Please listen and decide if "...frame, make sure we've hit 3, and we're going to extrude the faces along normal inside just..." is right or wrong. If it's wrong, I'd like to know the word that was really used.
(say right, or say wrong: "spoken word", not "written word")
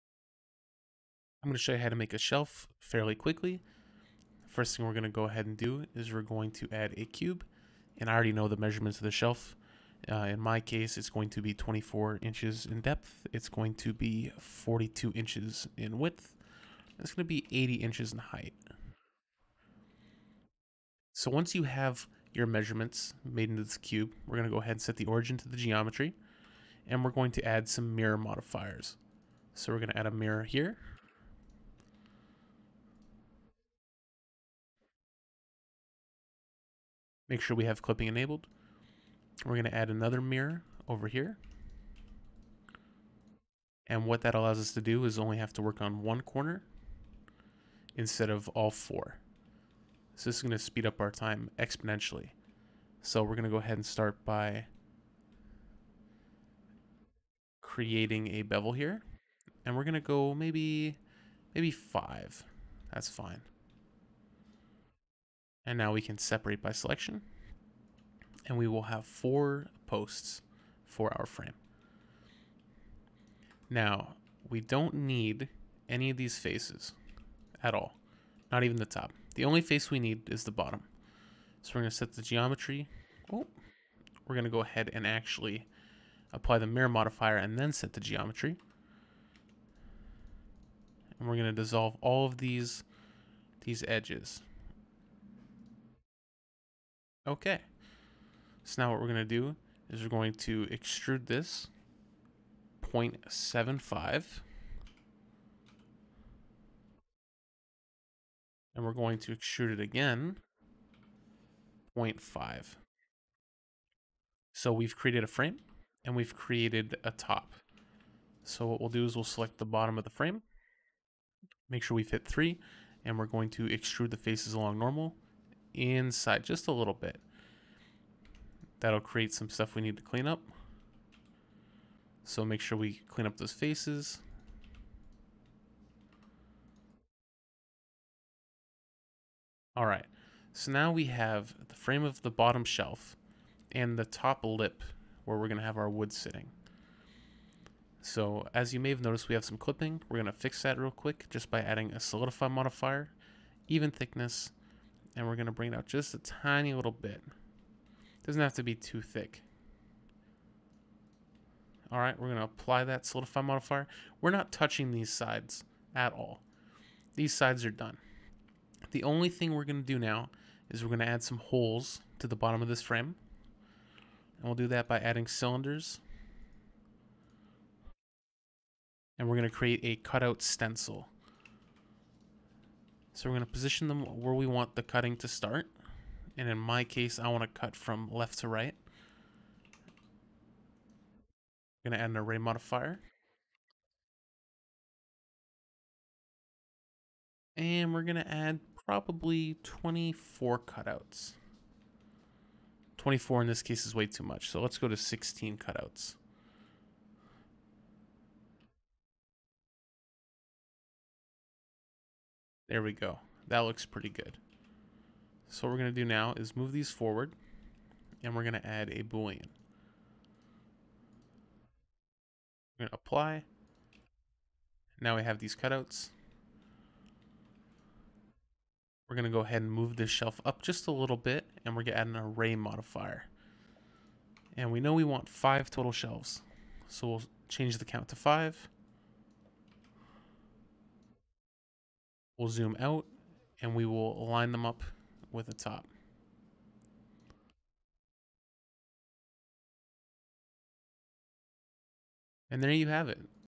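right.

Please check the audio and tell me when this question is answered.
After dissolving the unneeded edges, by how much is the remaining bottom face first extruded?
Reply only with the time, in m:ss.
1:42.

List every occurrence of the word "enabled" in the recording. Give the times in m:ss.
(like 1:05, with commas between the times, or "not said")
0:38.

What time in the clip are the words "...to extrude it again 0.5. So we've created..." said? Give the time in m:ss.
1:49.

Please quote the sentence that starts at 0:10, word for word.
Uh, in my case, it's going to be 24 inches in depth.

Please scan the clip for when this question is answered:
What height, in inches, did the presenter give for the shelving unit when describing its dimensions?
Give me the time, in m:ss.
0:17.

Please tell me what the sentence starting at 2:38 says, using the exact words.
Doesn't have to be too thick.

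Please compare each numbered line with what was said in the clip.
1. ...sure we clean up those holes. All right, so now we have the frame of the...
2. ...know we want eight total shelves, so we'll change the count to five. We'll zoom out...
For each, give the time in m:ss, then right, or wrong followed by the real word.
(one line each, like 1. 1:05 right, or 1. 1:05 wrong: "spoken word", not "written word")
1. 2:12 wrong: "faces", not "holes"
2. 3:54 wrong: "five", not "eight".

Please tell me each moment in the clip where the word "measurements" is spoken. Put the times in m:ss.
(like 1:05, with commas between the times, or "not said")
0:08, 0:22.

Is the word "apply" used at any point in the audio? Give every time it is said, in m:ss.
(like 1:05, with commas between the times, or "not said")
1:26, 2:42, 3:42.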